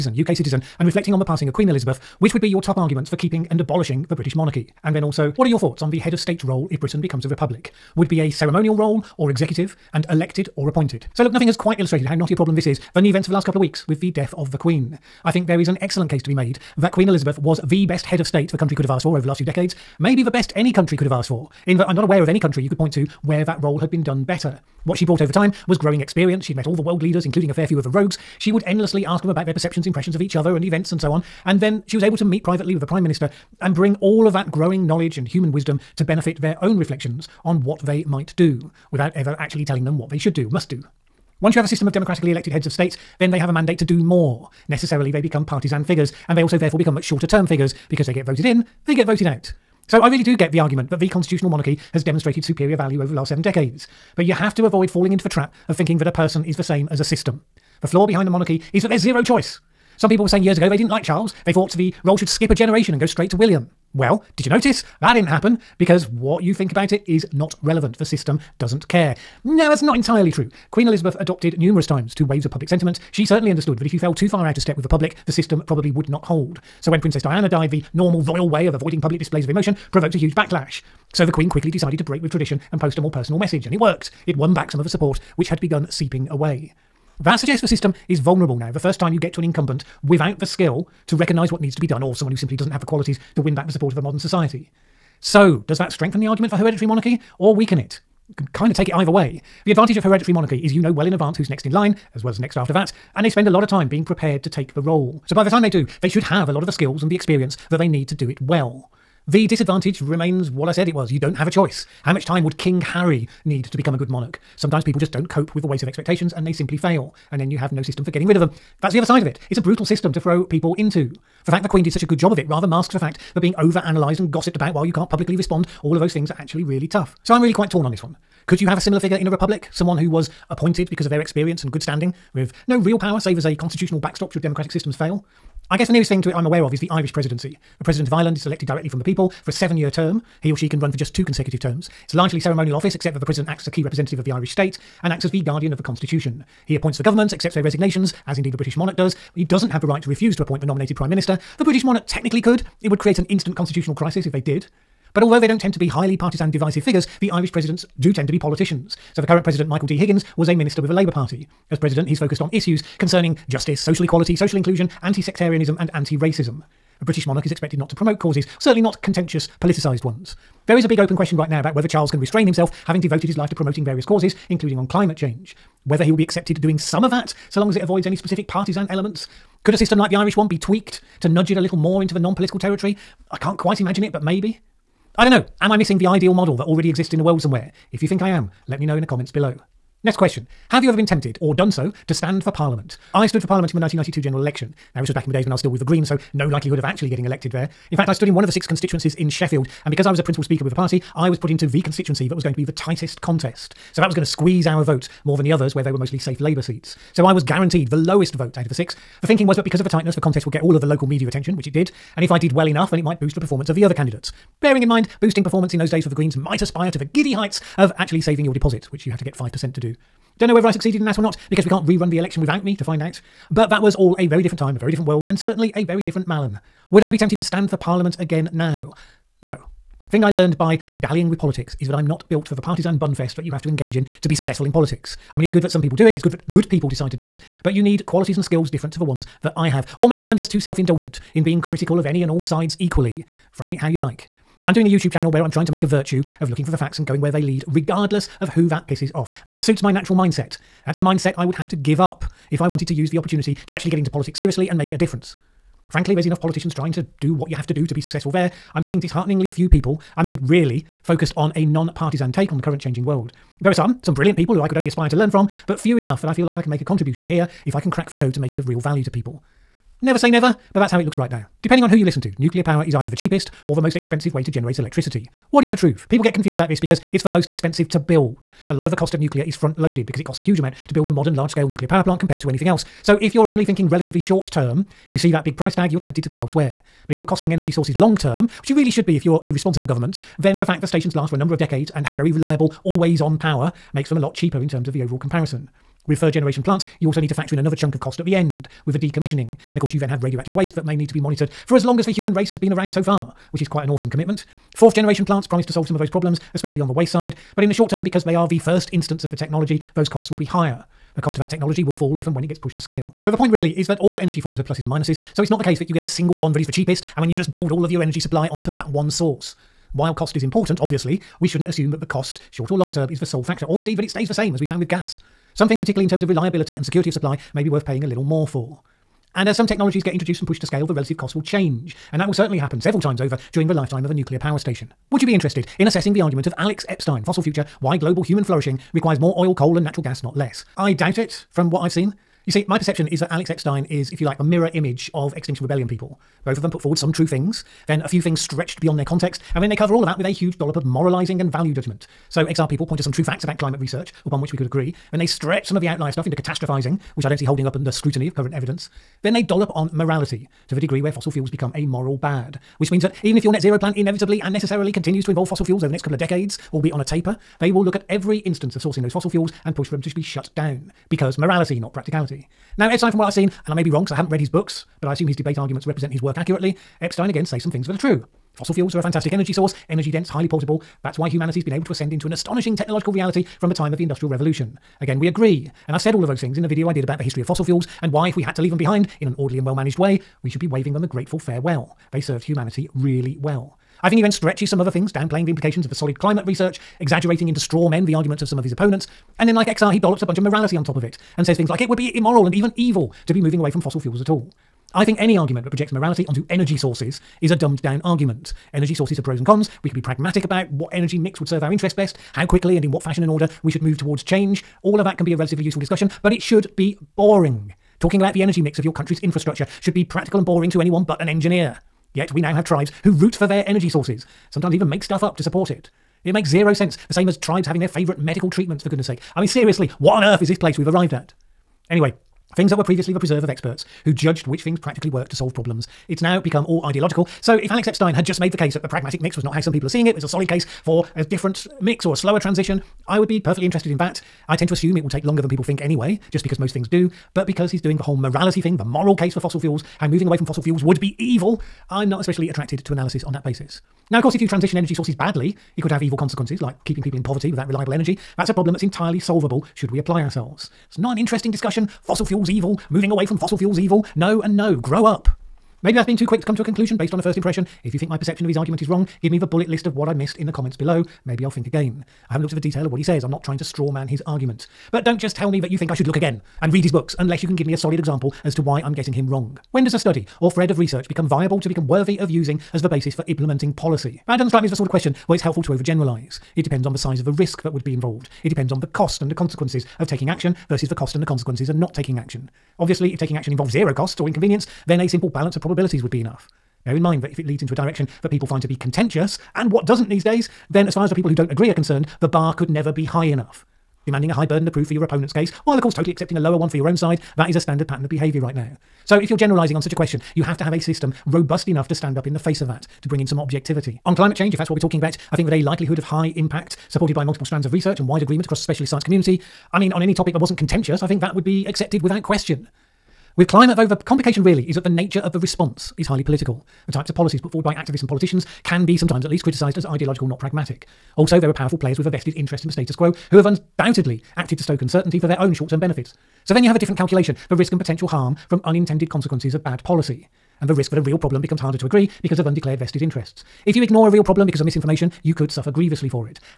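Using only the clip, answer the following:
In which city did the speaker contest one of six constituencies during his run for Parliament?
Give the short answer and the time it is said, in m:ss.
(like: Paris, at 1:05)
Sheffield, at 3:19.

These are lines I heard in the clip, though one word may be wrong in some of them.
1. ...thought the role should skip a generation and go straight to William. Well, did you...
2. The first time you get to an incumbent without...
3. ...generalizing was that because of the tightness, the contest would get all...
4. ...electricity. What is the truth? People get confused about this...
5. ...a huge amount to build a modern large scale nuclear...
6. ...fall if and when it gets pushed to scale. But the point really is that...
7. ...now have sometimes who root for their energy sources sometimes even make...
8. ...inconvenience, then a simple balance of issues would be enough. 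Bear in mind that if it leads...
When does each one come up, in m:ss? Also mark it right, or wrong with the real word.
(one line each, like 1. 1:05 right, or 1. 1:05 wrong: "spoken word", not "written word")
1. 1:01 right
2. 1:28 right
3. 3:29 wrong: "thinking", not "generalizing"
4. 4:34 right
5. 4:40 right
6. 5:11 right
7. 7:02 wrong: "tribes", not "sometimes"
8. 8:14 wrong: "probabilities", not "issues".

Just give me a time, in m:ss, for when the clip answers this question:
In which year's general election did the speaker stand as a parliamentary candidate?
3:13.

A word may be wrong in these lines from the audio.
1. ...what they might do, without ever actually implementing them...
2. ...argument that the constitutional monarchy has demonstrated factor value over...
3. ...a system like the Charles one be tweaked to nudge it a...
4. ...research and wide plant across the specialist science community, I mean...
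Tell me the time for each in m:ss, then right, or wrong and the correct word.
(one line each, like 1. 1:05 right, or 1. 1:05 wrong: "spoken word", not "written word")
1. 0:37 wrong: "telling", not "implementing"
2. 0:50 wrong: "superior", not "factor"
3. 2:59 wrong: "Irish", not "Charles"
4. 8:37 wrong: "agreement", not "plant".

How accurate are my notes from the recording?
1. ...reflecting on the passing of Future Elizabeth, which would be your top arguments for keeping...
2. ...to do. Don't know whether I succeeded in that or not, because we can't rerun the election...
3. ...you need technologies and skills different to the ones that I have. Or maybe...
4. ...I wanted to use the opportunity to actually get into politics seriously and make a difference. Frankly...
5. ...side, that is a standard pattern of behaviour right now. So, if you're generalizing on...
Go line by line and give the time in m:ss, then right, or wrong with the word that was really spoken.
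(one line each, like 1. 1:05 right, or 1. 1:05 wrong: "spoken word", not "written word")
1. 0:00 wrong: "Queen", not "Future"
2. 3:39 right
3. 3:57 wrong: "qualities", not "technologies"
4. 4:12 right
5. 8:26 right.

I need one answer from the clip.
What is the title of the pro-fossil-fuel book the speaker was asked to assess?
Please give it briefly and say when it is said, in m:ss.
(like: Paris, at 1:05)
Fossil Future, at 5:37.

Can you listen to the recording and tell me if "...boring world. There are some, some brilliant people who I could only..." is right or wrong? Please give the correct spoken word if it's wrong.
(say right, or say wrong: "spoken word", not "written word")
wrong: "changing", not "boring".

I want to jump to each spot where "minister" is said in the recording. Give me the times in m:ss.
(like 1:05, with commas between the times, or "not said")
0:33, 2:31, 2:40.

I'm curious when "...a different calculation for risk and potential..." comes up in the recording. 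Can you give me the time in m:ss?
8:56.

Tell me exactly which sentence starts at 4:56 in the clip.
With third generation plants, you also need to factor in another chunk of cost at the end with the decommissioning.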